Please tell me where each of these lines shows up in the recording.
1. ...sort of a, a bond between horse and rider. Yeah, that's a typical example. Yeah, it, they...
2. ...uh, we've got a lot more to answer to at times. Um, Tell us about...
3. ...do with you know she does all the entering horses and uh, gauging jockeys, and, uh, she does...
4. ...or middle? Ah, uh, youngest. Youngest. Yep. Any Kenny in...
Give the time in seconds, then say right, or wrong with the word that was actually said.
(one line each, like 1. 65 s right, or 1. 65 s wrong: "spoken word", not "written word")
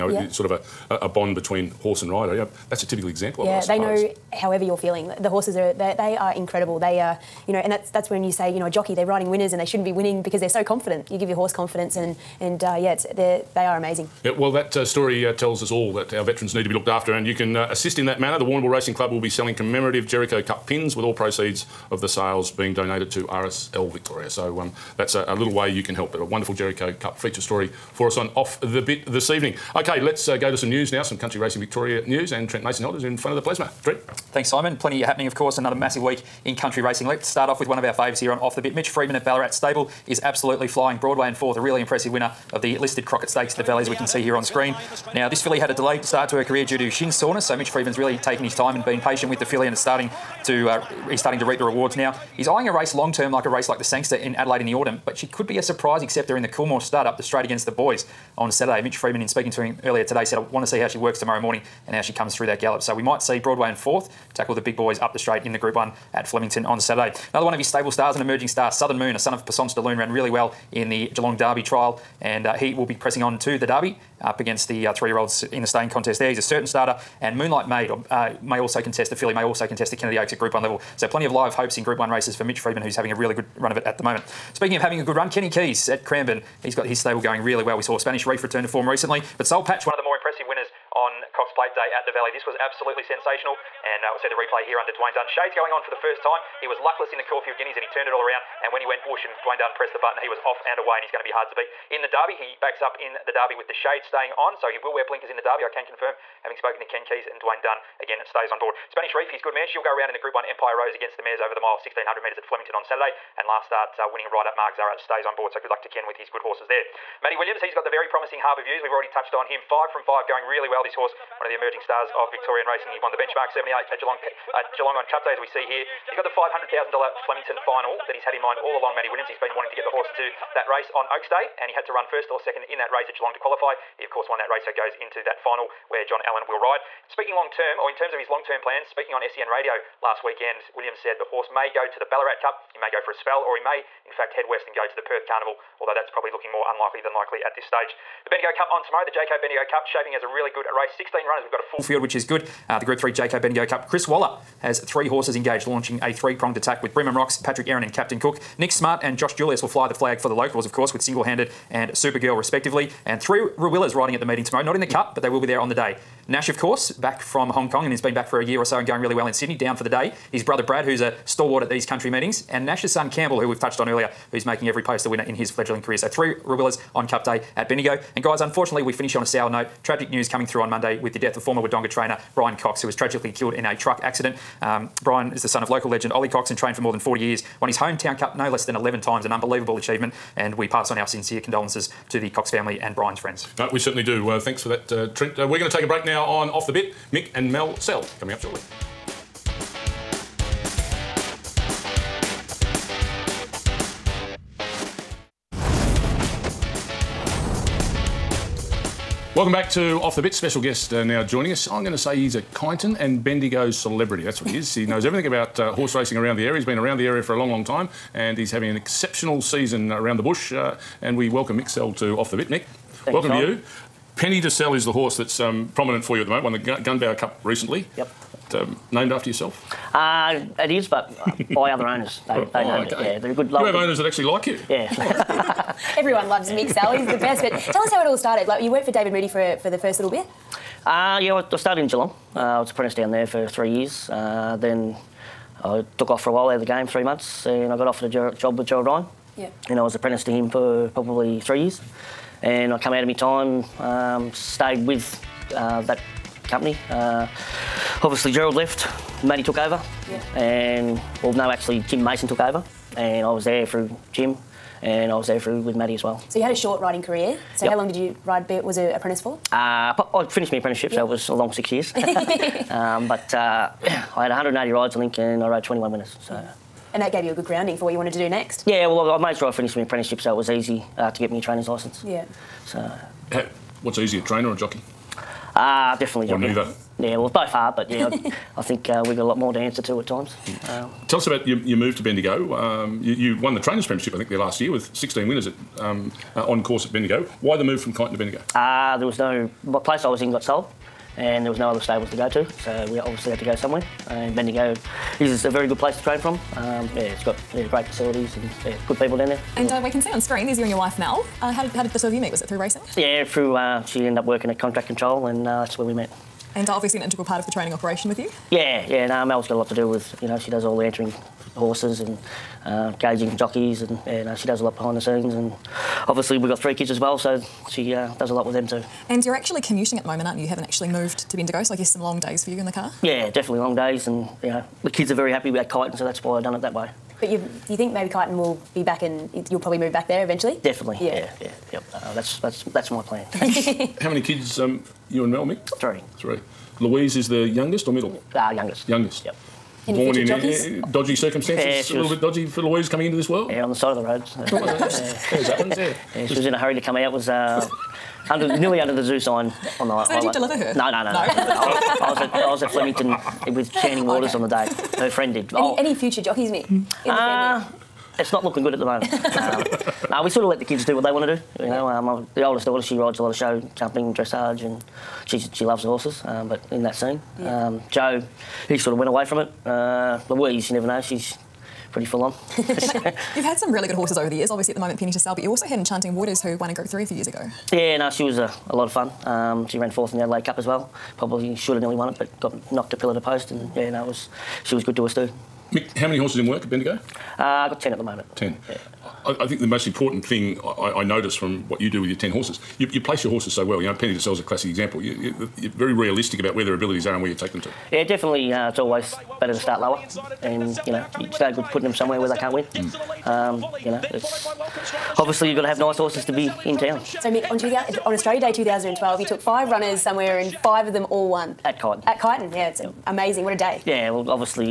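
1. 0 s right
2. 288 s right
3. 319 s right
4. 347 s wrong: "Born", not "Kenny".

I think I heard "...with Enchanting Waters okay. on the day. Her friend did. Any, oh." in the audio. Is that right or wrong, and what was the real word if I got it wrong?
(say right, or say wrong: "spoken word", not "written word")
right.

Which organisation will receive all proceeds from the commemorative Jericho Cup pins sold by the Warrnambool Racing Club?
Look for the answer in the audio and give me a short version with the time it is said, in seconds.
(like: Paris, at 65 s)
RSL Victoria, at 23 s.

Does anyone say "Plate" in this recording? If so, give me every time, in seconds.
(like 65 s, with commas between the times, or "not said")
91 s.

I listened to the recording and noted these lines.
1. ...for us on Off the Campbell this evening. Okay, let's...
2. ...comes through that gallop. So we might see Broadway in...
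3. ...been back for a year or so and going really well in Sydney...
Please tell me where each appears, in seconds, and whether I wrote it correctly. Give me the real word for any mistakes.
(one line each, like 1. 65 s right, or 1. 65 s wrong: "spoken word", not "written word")
1. 27 s wrong: "Bit", not "Campbell"
2. 62 s right
3. 167 s right.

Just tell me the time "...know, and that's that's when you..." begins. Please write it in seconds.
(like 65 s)
7 s.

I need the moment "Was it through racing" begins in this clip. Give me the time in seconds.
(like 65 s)
312 s.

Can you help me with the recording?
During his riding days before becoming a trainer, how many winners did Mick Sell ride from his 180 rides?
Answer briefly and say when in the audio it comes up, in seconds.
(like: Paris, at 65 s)
21, at 275 s.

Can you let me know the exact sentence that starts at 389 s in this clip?
Um, she ran fourth in the Adelaide Cup as well.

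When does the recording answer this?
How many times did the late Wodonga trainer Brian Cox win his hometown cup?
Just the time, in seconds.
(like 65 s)
188 s.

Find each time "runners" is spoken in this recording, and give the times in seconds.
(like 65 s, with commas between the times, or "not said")
151 s, 419 s.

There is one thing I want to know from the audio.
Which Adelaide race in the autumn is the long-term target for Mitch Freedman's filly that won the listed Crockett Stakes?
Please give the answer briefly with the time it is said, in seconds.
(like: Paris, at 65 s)
The Sangster, at 53 s.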